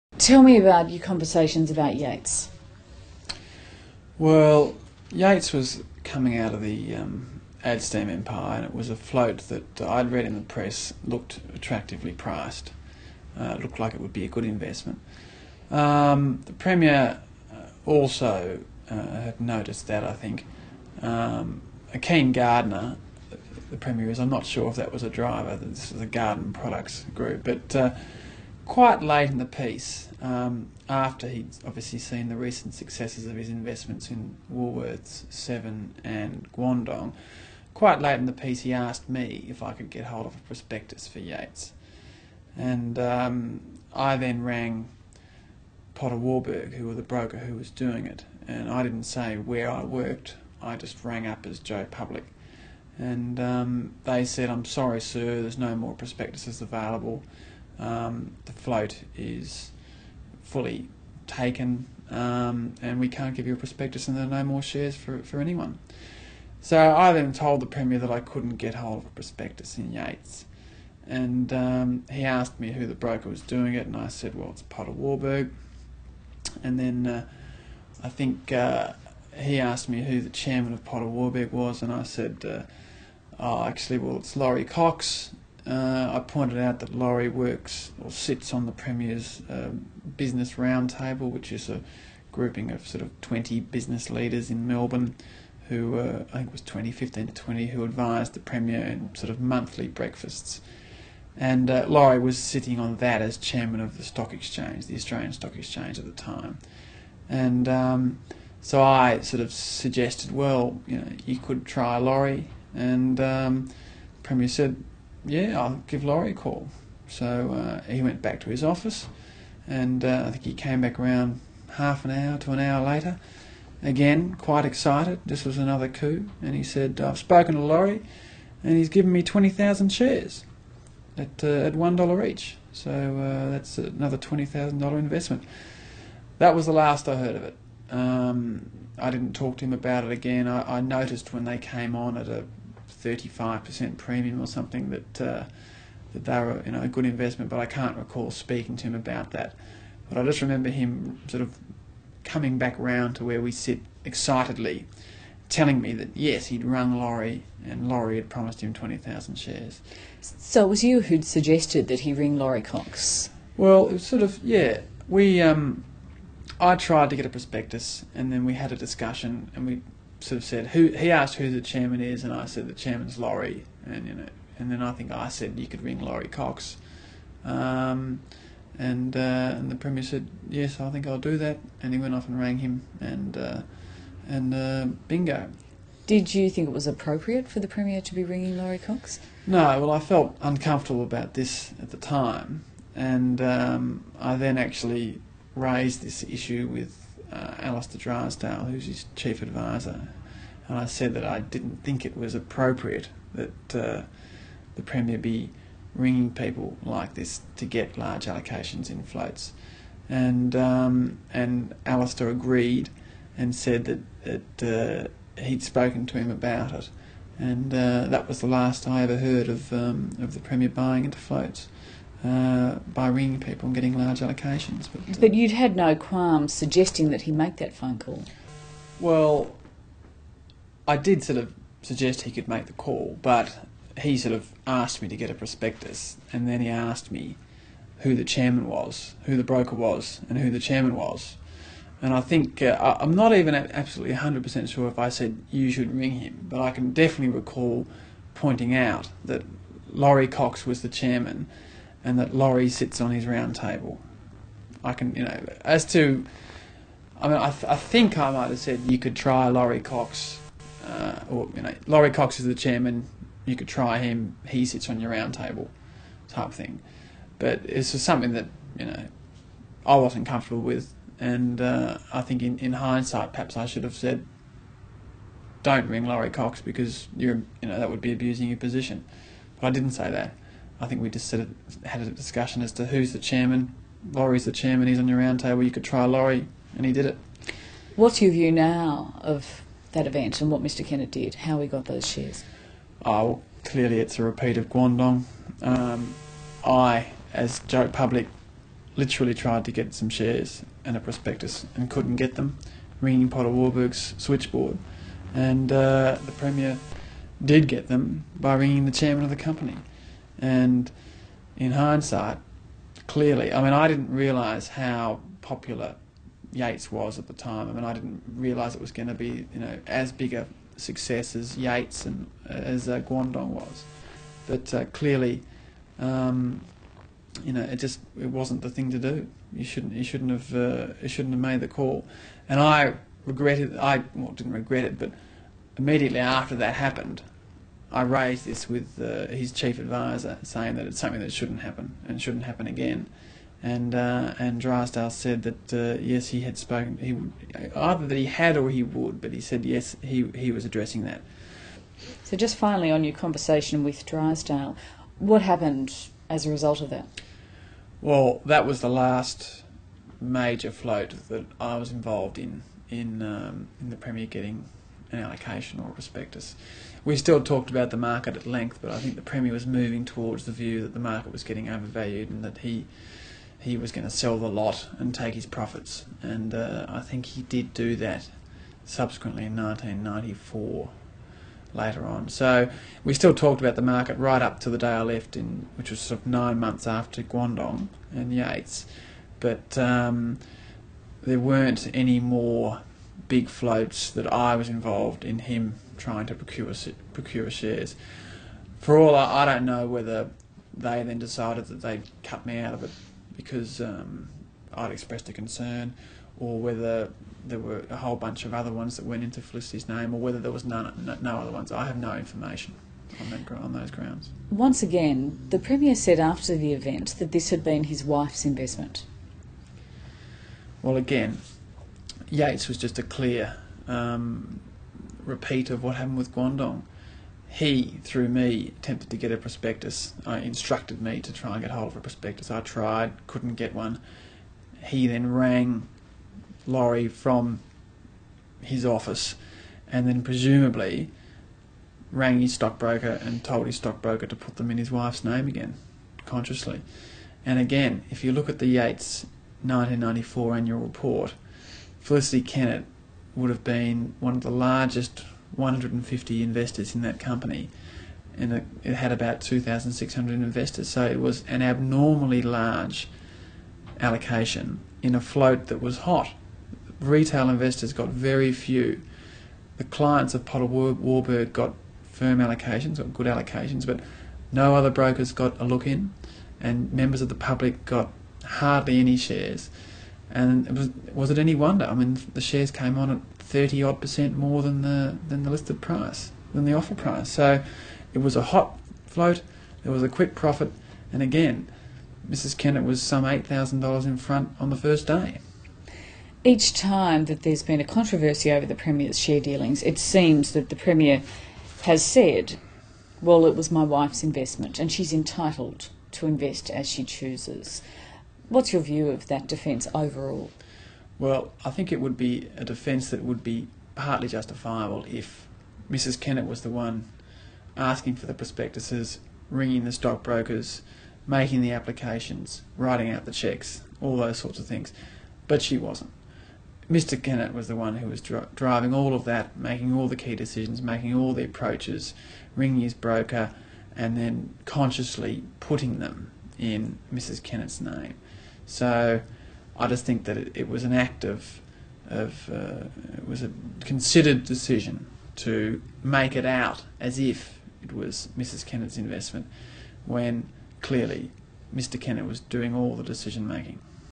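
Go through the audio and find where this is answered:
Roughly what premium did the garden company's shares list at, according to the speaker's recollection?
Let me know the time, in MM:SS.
02:23.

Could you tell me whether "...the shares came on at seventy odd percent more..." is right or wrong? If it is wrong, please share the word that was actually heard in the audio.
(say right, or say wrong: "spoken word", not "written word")
wrong: "thirty", not "seventy".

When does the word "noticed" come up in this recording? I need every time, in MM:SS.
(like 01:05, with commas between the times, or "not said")
00:19, 02:20.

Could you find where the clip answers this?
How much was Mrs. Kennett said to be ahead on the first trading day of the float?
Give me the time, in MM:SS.
08:13.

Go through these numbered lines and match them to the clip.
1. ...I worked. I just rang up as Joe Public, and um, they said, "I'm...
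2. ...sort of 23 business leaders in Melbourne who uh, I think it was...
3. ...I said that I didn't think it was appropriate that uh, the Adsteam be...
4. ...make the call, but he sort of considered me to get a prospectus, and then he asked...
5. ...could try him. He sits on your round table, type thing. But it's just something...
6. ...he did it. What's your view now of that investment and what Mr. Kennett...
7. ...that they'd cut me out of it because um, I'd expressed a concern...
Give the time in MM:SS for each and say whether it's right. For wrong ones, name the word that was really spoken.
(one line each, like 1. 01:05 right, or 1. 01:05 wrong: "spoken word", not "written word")
1. 00:49 right
2. 01:32 wrong: "20", not "23"
3. 03:20 wrong: "Premier", not "Adsteam"
4. 03:52 wrong: "asked", not "considered"
5. 04:23 right
6. 04:46 wrong: "event", not "investment"
7. 06:41 right.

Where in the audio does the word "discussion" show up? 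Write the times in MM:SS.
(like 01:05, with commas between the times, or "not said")
02:48, 04:42.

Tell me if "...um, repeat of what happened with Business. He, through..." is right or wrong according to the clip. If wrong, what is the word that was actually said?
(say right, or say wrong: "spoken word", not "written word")
wrong: "Guangdong", not "Business".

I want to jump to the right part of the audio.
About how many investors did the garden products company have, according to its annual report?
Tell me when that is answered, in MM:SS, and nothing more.
07:39.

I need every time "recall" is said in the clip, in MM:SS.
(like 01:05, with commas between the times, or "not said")
02:27, 04:07.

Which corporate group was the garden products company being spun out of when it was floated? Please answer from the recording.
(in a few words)
Adsteam.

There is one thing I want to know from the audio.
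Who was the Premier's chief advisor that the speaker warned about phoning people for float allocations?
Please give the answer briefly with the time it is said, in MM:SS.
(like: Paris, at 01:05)
Alistair Drysdale, at 03:17.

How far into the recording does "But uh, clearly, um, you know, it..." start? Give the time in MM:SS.
05:24.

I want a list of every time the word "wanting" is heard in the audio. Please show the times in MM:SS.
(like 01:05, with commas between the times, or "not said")
not said.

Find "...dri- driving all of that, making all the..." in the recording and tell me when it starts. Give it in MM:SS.
08:48.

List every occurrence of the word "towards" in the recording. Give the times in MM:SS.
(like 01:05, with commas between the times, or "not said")
06:10.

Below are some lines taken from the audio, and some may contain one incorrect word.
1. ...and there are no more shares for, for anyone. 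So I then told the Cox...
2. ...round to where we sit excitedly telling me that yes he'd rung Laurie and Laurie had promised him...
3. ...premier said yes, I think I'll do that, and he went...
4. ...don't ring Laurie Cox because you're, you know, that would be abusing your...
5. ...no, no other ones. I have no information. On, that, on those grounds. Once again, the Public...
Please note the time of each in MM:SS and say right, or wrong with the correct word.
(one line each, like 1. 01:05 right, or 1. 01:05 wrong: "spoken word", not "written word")
1. 01:04 wrong: "Premier", not "Cox"
2. 02:32 right
3. 02:59 right
4. 04:35 right
5. 06:51 wrong: "Premier", not "Public".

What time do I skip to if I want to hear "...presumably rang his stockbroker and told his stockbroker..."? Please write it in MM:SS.
07:20.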